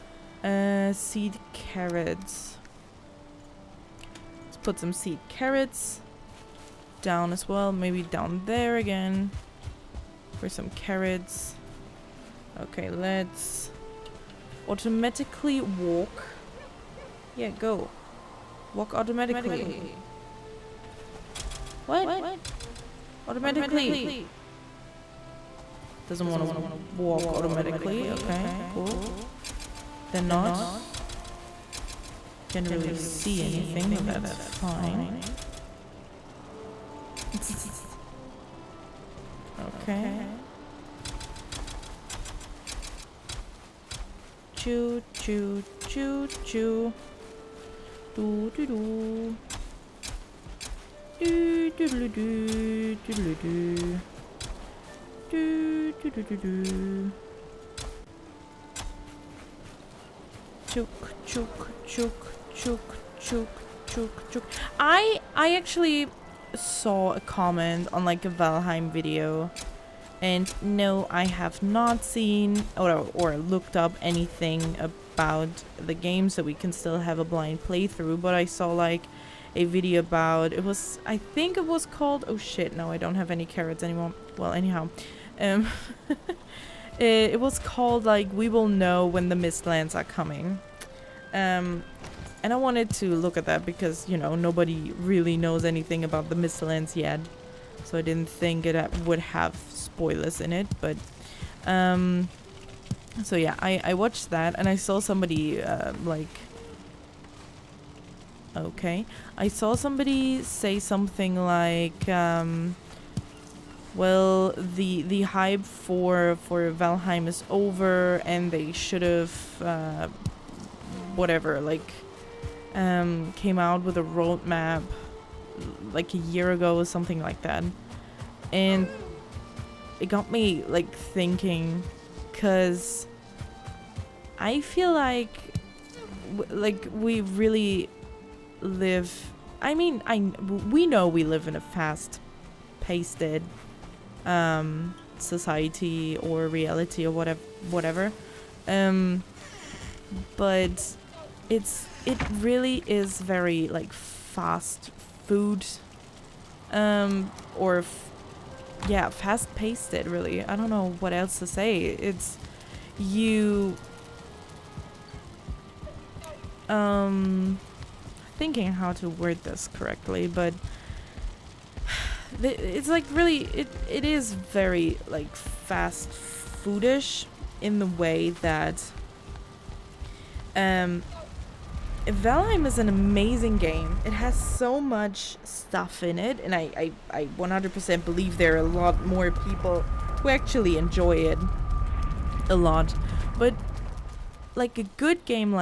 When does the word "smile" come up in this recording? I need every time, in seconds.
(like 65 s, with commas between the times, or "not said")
not said.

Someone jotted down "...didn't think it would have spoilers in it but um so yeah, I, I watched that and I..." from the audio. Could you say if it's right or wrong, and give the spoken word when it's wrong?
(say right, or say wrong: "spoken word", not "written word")
right.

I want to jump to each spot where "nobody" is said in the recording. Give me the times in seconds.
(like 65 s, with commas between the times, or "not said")
94 s.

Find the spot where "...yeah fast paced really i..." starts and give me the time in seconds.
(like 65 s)
158 s.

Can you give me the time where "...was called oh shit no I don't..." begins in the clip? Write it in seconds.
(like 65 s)
81 s.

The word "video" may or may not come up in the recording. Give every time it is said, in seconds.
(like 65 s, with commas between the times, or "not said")
68 s, 79 s.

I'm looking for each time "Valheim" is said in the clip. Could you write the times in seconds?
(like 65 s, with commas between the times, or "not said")
68 s, 116 s, 182 s.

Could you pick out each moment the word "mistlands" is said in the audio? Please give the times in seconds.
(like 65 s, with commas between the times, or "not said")
89 s, 96 s.